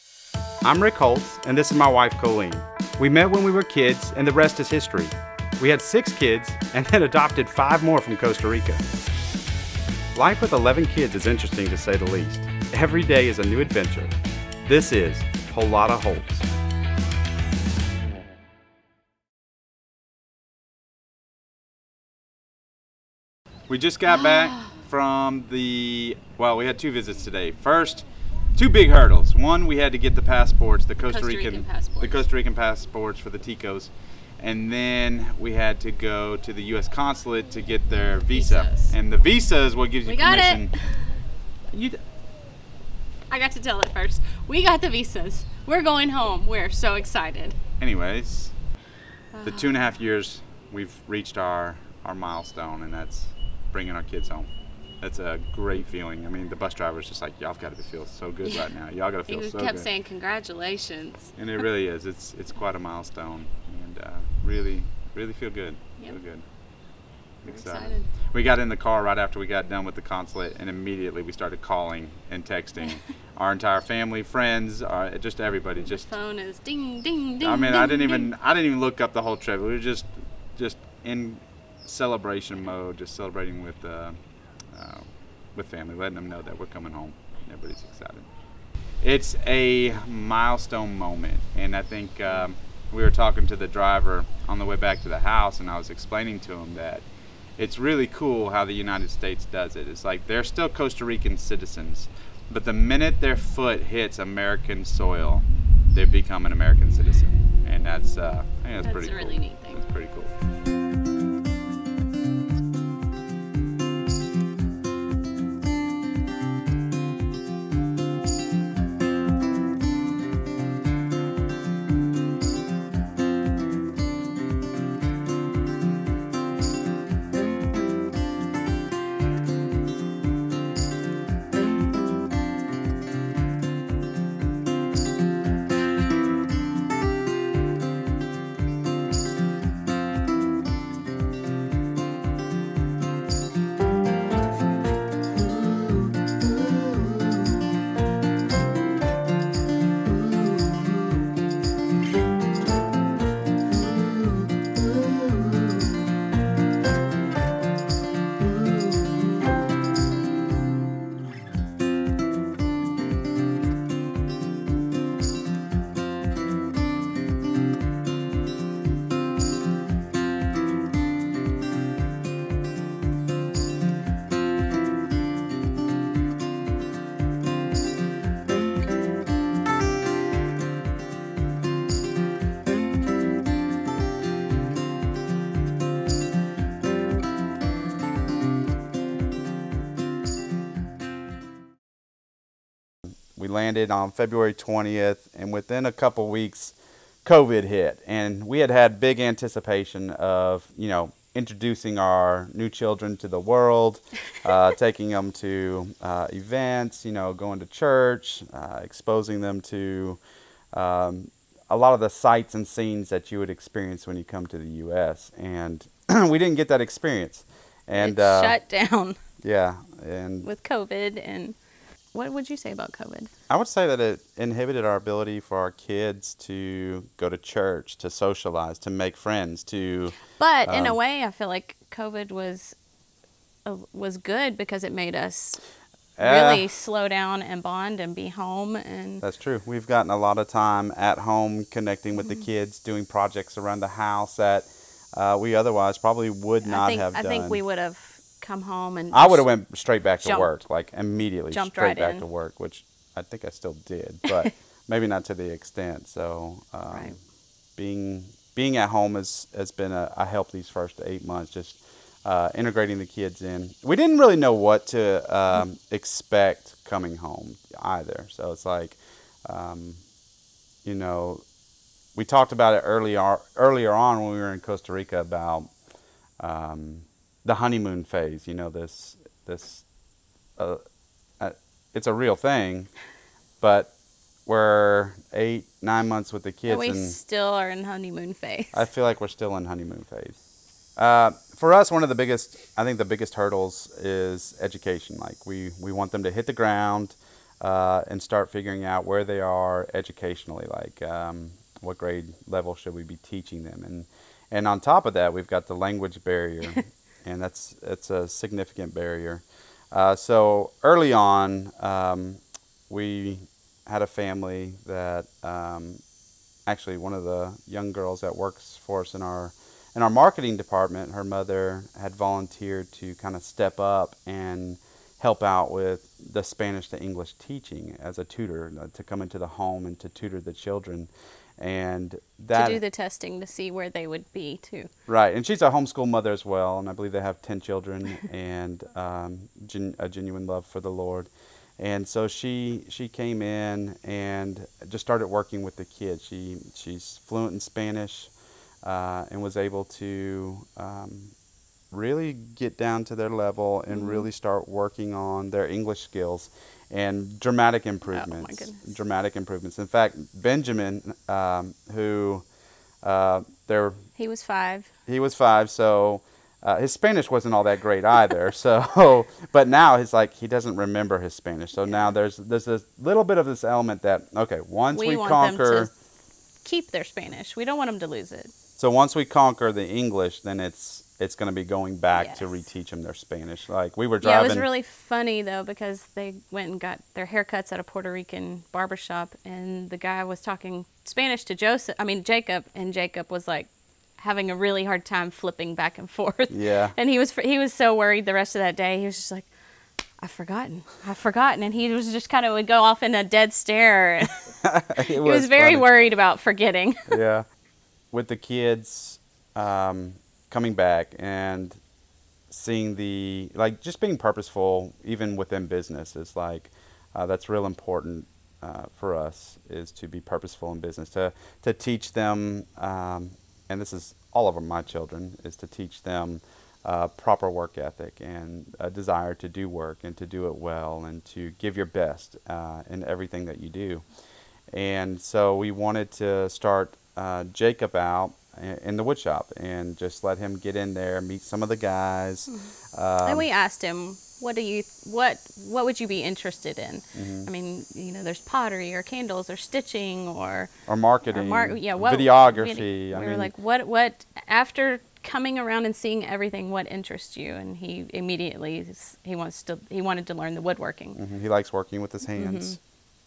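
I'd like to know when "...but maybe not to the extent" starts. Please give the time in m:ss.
4:14.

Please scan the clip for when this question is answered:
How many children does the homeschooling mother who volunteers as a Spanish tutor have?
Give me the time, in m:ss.
5:37.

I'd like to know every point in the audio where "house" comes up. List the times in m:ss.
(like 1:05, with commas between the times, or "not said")
1:35, 4:03.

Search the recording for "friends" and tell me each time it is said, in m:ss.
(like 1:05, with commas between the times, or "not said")
1:14, 3:49.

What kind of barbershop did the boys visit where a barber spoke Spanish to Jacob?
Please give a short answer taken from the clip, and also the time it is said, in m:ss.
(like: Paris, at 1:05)
Puerto Rican, at 6:27.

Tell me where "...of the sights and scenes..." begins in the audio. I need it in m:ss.
3:31.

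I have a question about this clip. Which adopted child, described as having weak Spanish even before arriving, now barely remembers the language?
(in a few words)
Benjamin.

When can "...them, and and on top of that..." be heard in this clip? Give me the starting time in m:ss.
5:03.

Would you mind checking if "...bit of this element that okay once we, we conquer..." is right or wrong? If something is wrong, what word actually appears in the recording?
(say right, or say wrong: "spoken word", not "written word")
right.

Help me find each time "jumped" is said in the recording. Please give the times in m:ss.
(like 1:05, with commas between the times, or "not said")
4:10.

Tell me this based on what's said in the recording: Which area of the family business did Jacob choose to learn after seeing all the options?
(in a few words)
woodworking.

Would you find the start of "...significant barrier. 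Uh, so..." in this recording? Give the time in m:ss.
5:08.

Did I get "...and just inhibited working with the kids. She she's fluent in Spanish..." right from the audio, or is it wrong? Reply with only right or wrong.
wrong.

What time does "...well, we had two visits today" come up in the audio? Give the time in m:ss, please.
0:26.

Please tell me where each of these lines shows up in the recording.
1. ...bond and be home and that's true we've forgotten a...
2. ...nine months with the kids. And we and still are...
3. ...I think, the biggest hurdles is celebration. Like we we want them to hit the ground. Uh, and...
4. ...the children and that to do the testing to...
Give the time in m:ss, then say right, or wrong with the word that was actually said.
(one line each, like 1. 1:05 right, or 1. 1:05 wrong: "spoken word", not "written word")
1. 3:57 wrong: "gotten", not "forgotten"
2. 4:45 right
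3. 4:52 wrong: "education", not "celebration"
4. 5:30 right.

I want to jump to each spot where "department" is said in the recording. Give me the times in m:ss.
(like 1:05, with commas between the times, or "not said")
5:20.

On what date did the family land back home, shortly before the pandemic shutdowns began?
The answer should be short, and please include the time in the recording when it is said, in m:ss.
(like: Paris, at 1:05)
February 20th, at 3:14.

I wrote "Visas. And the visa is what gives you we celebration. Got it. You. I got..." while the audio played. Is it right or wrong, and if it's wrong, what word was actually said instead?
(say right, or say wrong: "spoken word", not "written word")
wrong: "permission", not "celebration".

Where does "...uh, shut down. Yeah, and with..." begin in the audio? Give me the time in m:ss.
3:38.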